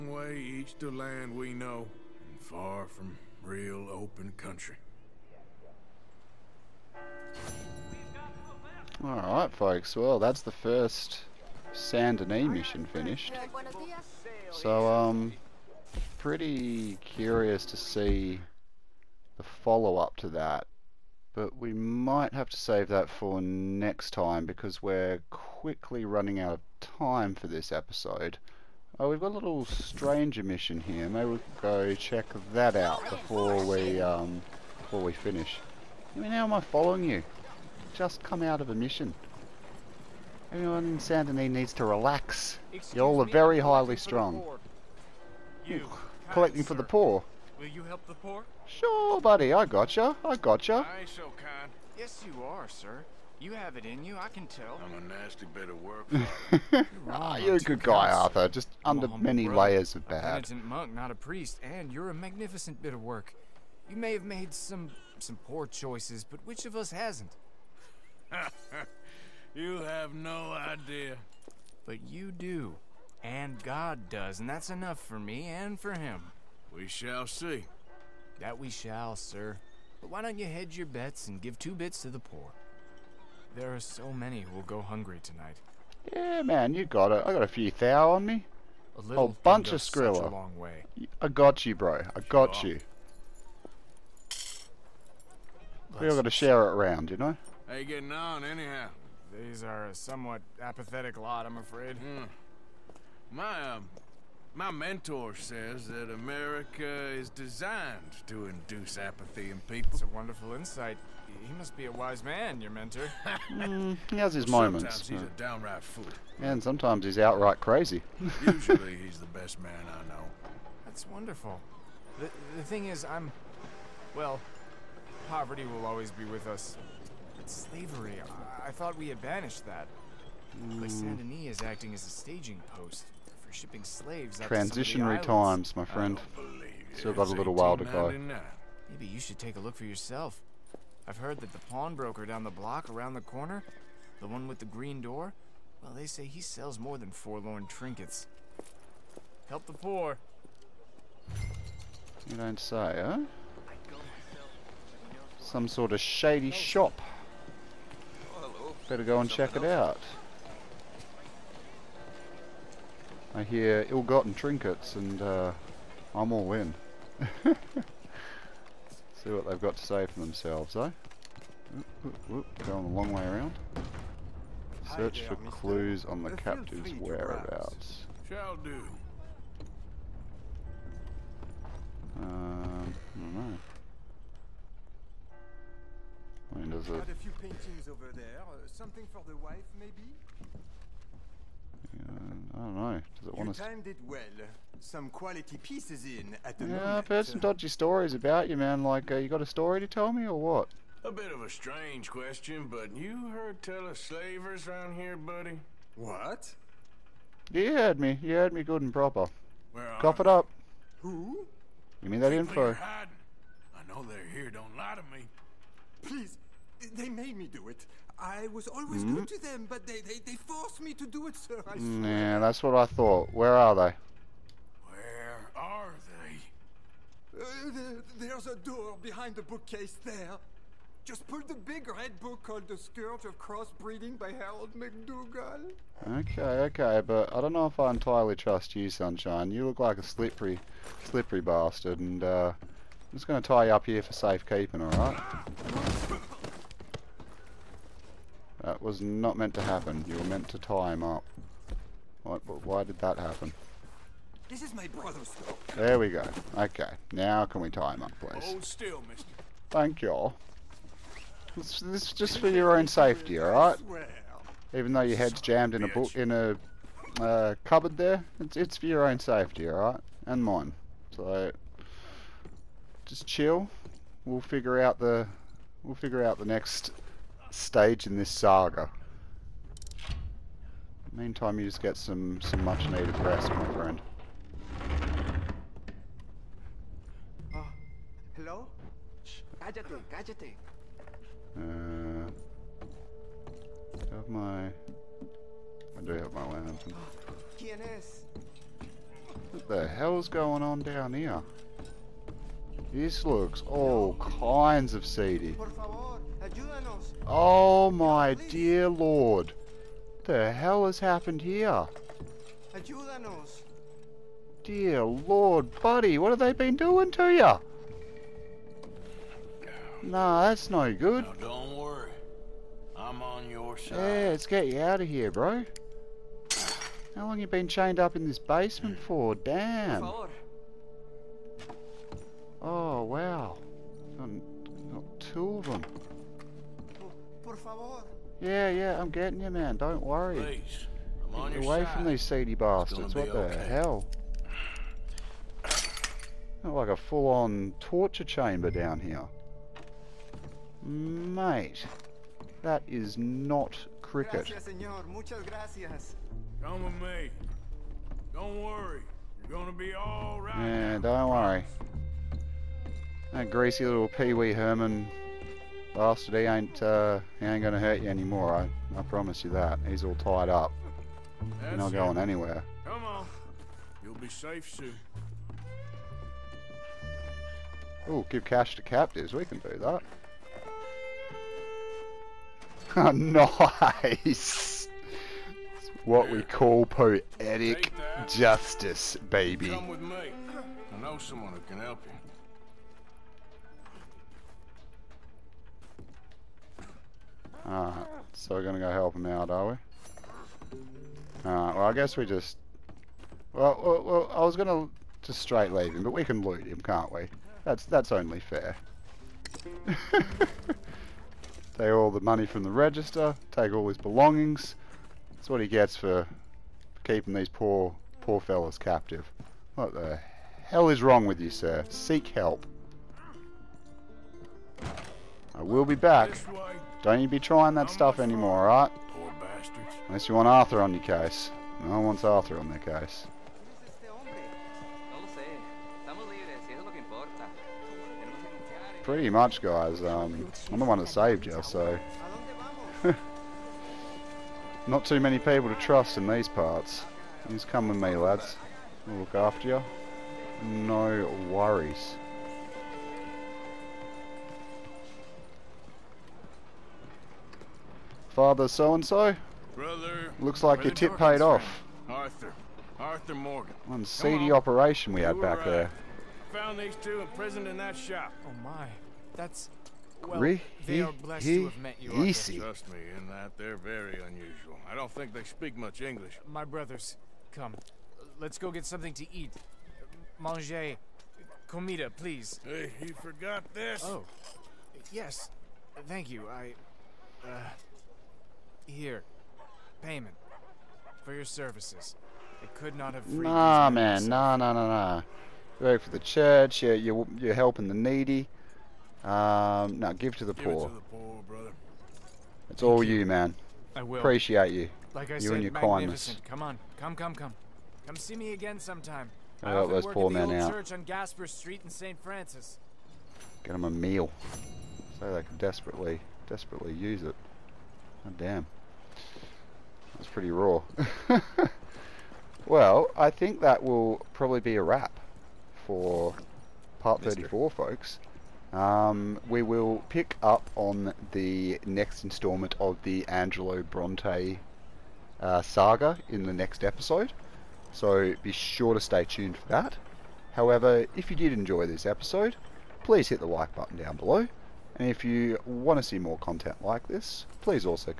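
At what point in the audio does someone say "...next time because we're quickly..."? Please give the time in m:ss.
0:23.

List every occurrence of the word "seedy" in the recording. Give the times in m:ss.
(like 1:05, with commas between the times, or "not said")
5:05, 5:42, 7:44.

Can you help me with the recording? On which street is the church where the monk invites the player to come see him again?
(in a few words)
Gasper Street.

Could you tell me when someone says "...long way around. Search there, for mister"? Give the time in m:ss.
2:52.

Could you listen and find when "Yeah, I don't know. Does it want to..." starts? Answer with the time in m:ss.
3:11.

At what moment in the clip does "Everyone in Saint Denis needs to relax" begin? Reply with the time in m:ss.
0:40.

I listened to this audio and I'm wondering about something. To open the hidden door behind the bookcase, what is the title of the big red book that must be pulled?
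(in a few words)
The Scourge of Crossbreeding.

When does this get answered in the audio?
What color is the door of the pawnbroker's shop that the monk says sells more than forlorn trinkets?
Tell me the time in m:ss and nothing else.
2:24.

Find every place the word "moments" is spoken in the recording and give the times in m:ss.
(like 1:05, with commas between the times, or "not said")
1:54, 3:16.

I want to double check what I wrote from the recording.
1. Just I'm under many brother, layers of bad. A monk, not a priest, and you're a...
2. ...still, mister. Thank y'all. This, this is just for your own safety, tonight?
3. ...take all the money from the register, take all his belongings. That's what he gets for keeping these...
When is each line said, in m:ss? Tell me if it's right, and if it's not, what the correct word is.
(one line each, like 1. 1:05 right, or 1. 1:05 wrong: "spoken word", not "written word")
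1. 0:58 right
2. 4:18 wrong: "alright", not "tonight"
3. 6:49 right.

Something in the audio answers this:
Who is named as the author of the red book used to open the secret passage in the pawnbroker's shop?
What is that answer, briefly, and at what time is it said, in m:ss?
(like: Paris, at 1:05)
Harold McDougall, at 3:54.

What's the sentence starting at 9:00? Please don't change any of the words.
However, if you did enjoy this episode, please hit the like button down below.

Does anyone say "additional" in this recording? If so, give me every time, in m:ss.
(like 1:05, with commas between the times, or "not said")
not said.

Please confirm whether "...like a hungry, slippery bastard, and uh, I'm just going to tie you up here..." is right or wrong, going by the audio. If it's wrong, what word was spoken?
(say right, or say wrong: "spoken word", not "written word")
wrong: "slippery", not "hungry".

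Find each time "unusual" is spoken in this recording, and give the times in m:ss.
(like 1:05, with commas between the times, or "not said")
7:54.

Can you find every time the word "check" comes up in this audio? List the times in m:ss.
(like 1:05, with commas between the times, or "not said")
0:31, 2:39.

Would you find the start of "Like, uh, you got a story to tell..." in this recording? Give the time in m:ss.
3:18.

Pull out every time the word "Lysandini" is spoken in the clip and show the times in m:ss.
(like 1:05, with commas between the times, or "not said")
2:10.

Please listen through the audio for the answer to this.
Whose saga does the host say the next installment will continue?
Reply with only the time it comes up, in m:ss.
8:53.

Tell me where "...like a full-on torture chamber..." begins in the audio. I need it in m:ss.
5:46.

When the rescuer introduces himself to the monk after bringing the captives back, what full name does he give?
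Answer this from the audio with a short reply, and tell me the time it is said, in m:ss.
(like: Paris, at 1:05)
Arthur Morgan, at 7:42.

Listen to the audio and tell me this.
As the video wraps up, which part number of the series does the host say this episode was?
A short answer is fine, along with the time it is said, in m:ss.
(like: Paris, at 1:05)
34, at 8:47.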